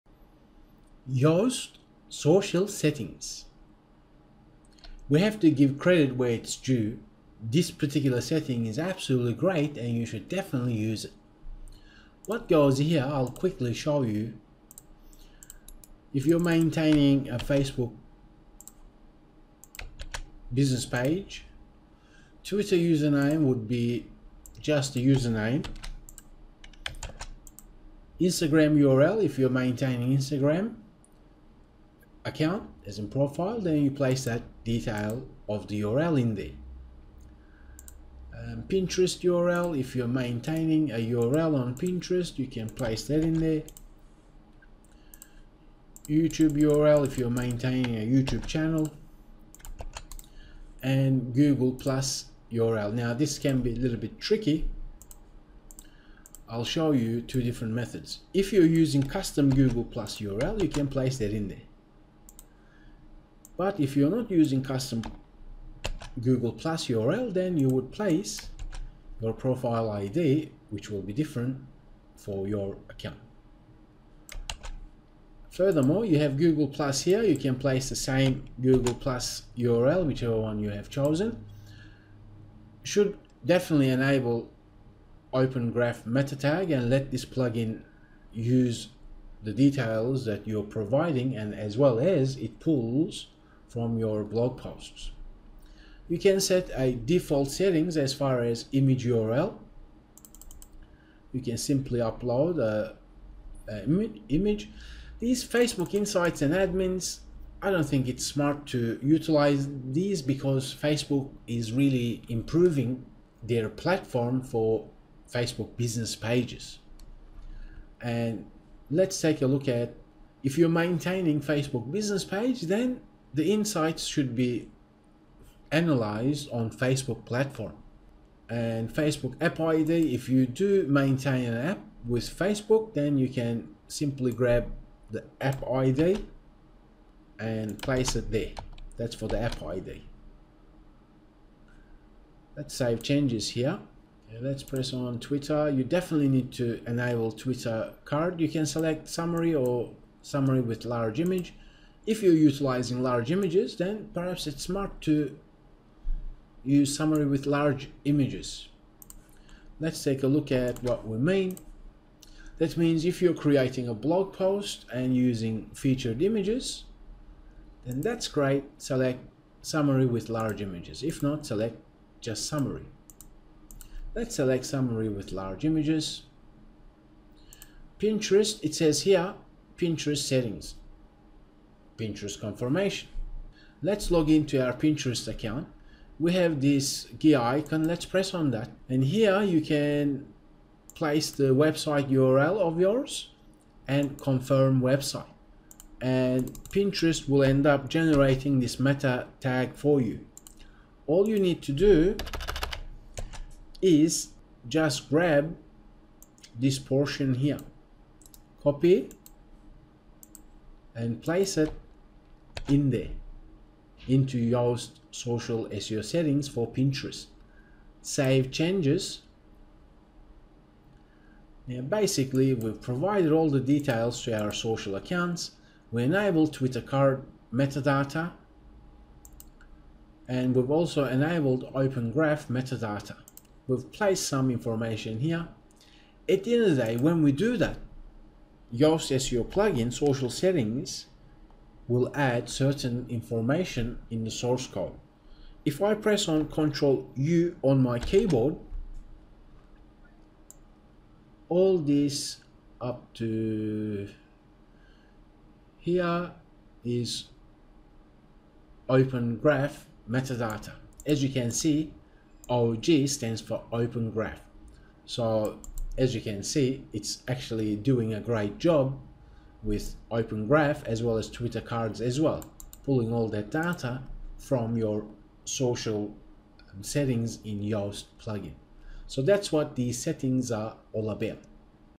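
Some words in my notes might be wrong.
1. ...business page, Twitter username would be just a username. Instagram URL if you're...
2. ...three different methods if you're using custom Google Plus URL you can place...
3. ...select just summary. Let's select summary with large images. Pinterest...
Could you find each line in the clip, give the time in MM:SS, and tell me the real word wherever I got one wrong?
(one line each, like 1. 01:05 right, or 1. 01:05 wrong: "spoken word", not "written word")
1. 00:20 right
2. 00:57 wrong: "two", not "three"
3. 02:51 right.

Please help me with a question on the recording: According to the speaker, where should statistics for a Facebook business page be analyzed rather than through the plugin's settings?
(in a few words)
Facebook platform.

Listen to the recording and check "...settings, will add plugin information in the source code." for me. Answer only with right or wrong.
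wrong.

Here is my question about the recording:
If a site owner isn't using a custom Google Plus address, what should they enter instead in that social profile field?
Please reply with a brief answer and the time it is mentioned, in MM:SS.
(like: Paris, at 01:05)
profile ID, at 01:09.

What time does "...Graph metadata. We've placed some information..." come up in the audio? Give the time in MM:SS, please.
03:52.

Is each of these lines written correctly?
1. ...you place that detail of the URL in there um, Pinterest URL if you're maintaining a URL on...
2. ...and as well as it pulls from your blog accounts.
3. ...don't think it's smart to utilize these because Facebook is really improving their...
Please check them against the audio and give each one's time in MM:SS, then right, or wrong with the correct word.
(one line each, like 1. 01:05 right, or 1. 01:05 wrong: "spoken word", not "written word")
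1. 00:33 right
2. 01:31 wrong: "posts", not "accounts"
3. 01:47 right.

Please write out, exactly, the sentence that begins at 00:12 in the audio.
What goes here, I'll quickly show you.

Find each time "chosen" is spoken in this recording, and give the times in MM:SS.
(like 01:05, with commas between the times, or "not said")
01:20.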